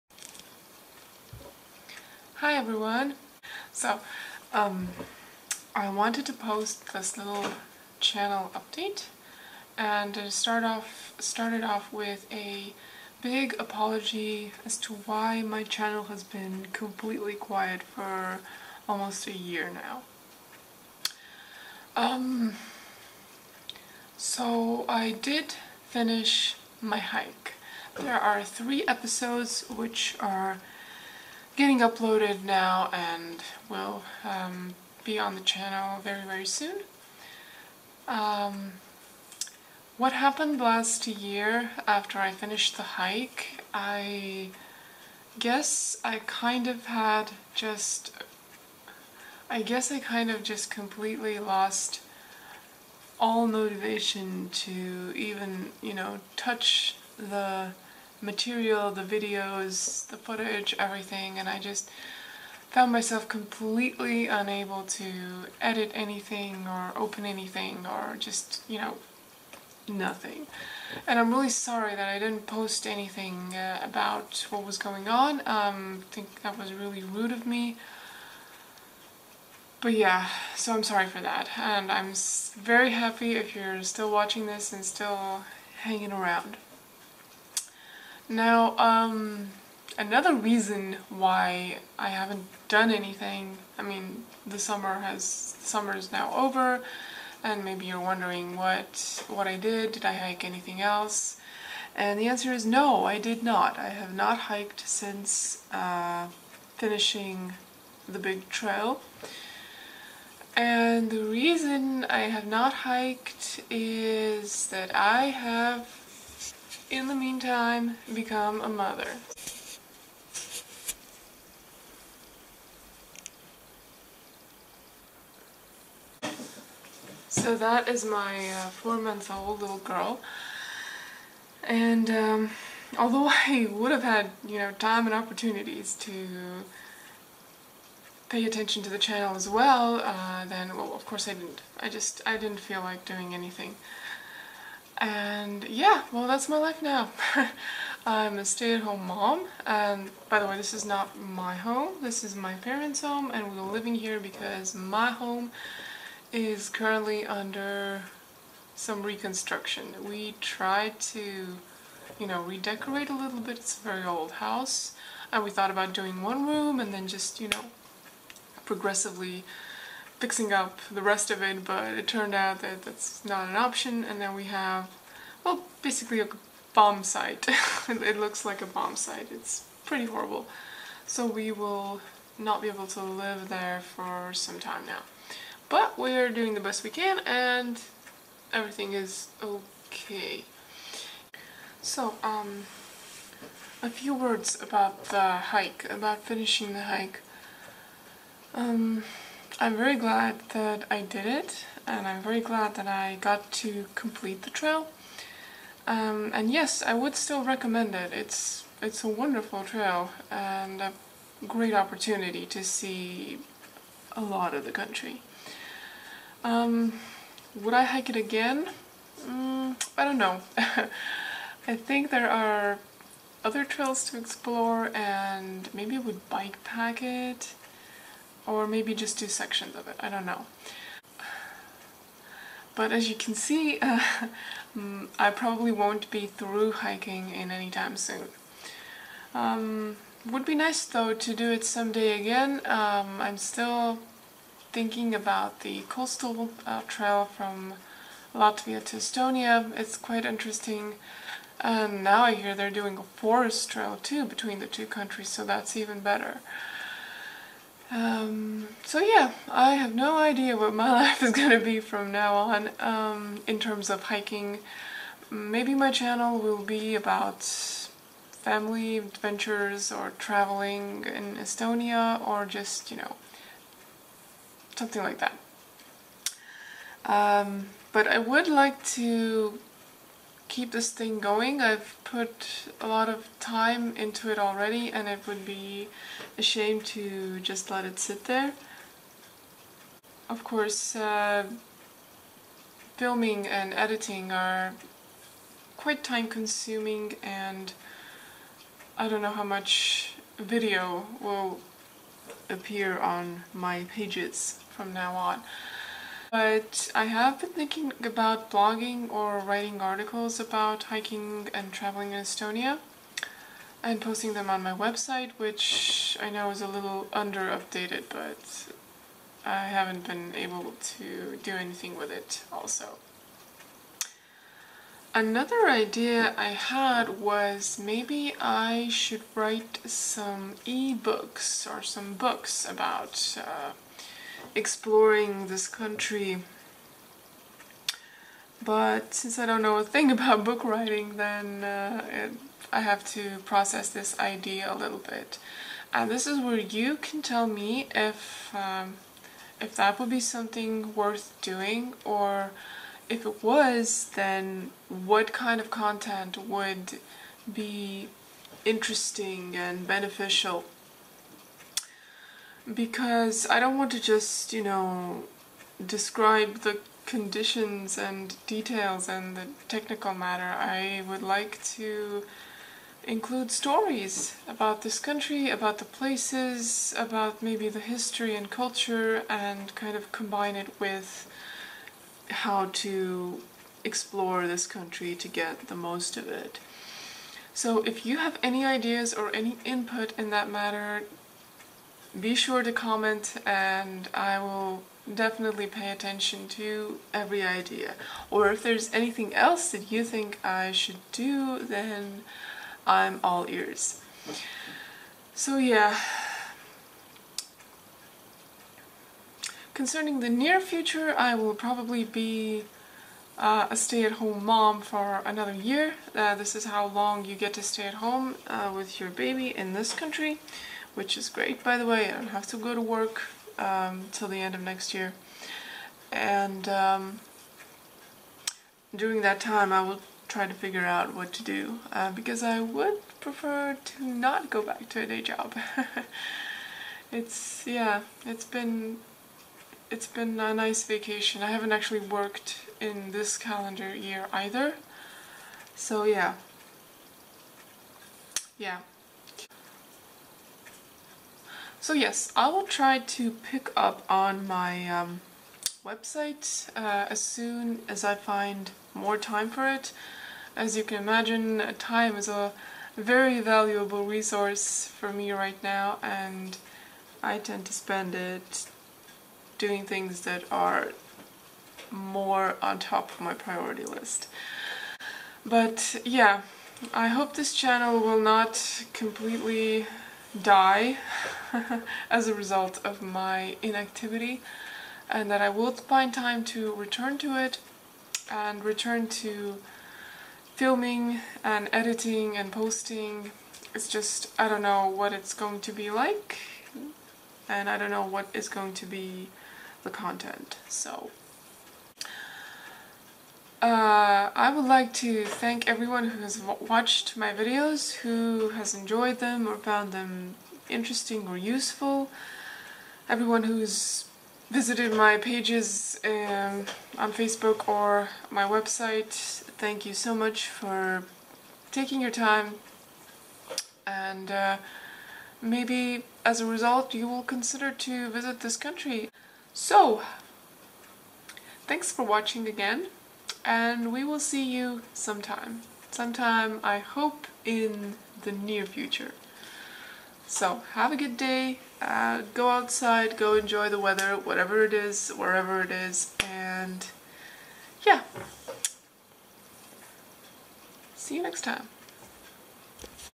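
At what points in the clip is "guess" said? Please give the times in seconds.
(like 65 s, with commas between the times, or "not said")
45 s, 49 s.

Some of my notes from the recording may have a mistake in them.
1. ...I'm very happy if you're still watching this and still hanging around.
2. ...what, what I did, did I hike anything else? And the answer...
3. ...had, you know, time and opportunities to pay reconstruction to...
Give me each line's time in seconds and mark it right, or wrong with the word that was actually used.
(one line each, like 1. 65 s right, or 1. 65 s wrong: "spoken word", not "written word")
1. 81 s right
2. 98 s right
3. 134 s wrong: "attention", not "reconstruction".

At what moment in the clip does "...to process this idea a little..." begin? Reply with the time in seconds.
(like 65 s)
343 s.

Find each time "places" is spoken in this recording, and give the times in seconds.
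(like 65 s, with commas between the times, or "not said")
375 s.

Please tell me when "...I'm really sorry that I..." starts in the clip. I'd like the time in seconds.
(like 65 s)
71 s.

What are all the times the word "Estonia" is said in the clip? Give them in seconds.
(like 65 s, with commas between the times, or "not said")
248 s, 271 s, 312 s.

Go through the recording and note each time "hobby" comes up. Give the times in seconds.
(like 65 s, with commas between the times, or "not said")
not said.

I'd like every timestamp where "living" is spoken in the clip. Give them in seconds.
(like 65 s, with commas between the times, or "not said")
153 s.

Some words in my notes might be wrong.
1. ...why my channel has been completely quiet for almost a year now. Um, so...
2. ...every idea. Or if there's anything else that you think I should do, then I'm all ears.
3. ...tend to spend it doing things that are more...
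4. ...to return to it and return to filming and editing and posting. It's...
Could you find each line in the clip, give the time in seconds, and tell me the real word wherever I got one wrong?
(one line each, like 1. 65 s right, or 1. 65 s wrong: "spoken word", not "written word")
1. 15 s right
2. 397 s right
3. 467 s right
4. 486 s right.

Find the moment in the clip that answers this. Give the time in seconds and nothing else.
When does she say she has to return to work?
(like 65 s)
424 s.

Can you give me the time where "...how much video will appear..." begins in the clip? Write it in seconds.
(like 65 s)
299 s.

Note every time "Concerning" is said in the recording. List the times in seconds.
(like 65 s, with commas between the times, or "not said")
409 s.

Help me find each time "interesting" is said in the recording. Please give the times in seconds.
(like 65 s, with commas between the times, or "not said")
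250 s, 358 s, 510 s.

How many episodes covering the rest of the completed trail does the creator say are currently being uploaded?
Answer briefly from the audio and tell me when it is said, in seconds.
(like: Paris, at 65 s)
3, at 28 s.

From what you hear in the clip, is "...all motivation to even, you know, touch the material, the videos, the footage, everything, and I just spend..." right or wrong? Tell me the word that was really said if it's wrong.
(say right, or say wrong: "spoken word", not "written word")
wrong: "found", not "spend".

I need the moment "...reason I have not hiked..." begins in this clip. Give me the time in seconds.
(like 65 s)
111 s.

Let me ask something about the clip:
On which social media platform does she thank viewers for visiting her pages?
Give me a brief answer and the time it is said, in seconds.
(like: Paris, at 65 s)
Facebook, at 517 s.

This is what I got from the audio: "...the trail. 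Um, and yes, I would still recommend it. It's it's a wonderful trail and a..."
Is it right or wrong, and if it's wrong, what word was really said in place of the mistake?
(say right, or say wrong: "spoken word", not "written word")
right.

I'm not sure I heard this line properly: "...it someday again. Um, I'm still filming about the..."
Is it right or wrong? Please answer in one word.
wrong.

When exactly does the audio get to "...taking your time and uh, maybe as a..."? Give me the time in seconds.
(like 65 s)
521 s.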